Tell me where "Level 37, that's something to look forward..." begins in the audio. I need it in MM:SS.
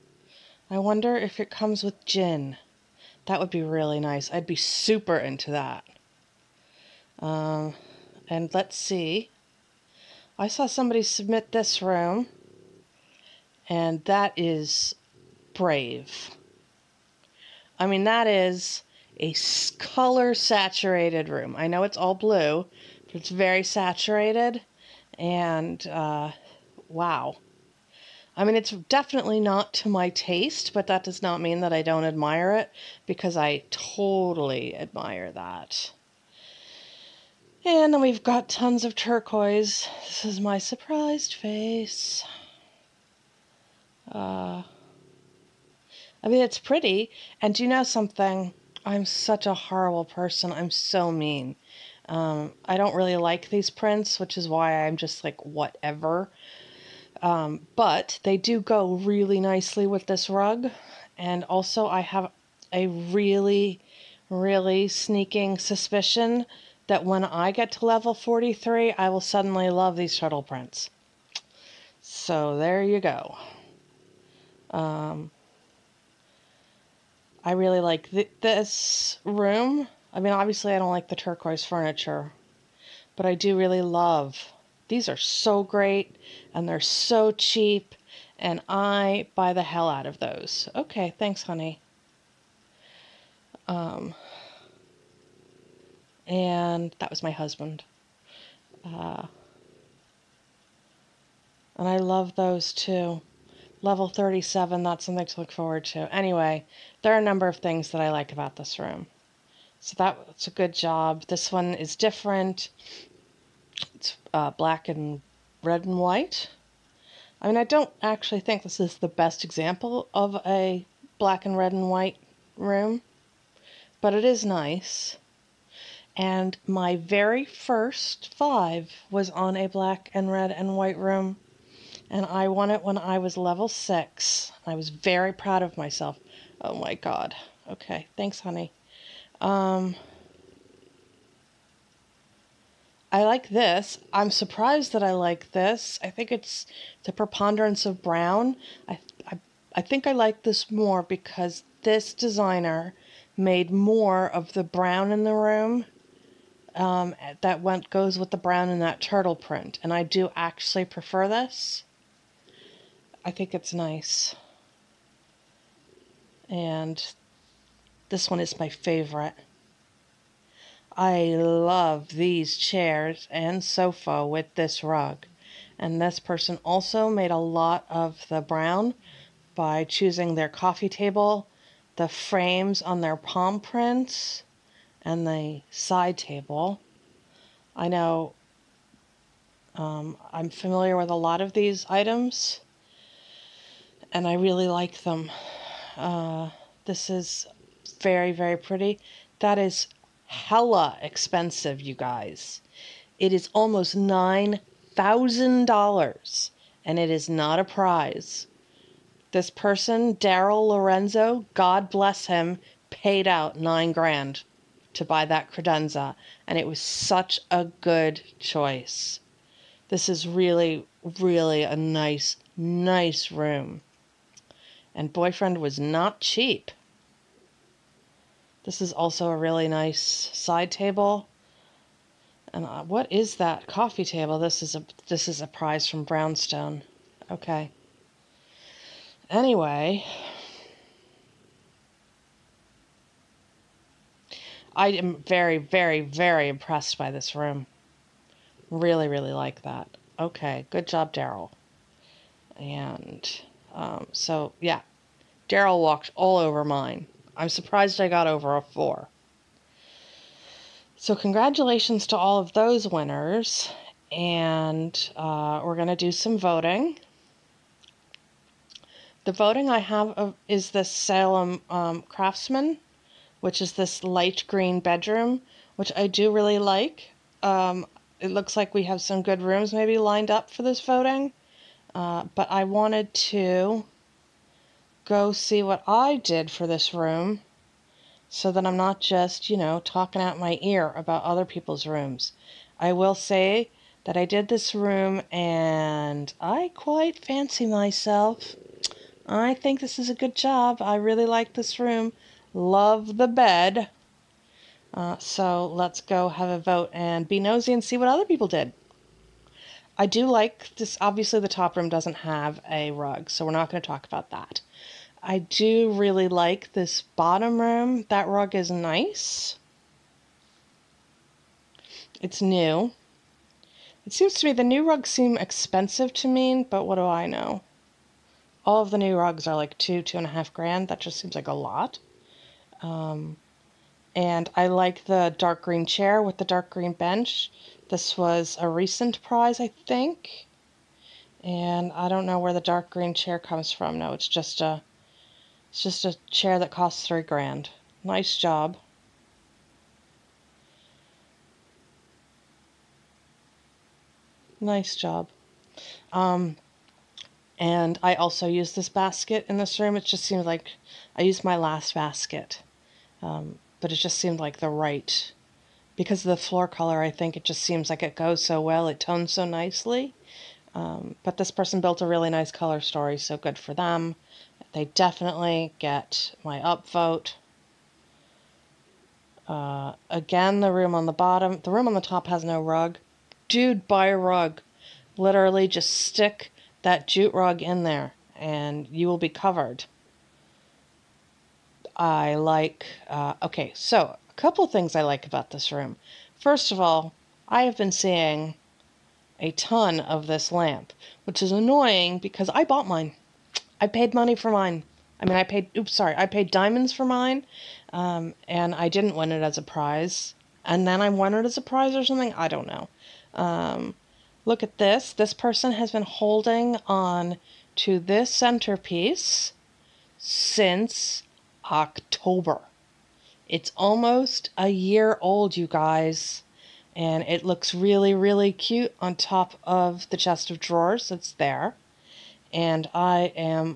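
01:43.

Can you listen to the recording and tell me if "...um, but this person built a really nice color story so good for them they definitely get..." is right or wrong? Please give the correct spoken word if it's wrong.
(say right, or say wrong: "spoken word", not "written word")
right.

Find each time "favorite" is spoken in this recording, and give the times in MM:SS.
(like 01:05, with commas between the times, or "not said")
02:48.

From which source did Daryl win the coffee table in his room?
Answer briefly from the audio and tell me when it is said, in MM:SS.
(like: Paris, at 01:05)
Brownstone, at 03:56.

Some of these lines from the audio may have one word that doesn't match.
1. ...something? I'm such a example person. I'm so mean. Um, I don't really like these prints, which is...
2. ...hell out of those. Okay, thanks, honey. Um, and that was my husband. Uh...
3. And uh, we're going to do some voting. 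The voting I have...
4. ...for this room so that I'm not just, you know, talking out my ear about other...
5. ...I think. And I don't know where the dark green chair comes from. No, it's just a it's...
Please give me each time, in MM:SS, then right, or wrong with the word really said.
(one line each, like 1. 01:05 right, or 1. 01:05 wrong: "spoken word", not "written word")
1. 00:47 wrong: "horrible", not "example"
2. 01:29 right
3. 04:24 right
4. 04:46 right
5. 05:39 right.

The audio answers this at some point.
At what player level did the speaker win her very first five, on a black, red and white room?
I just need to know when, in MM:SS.
02:13.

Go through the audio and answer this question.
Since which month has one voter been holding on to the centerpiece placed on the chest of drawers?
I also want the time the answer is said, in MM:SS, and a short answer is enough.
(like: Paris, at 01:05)
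October, at 07:01.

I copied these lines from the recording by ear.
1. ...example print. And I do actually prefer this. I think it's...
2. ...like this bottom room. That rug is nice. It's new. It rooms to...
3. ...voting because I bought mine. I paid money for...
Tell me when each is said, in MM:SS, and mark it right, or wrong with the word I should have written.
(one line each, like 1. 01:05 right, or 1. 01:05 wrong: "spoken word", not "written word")
1. 02:38 wrong: "turtle", not "example"
2. 05:16 wrong: "seems", not "rooms"
3. 06:41 wrong: "annoying", not "voting".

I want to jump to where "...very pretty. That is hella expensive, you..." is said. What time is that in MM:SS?
03:18.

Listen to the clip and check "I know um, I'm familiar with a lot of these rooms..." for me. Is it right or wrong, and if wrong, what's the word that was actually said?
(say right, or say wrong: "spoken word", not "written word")
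wrong: "items", not "rooms".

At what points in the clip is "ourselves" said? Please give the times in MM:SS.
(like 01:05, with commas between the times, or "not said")
not said.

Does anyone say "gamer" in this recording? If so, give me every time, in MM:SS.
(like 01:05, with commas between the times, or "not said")
not said.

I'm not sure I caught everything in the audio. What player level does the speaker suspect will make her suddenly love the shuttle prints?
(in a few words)
43.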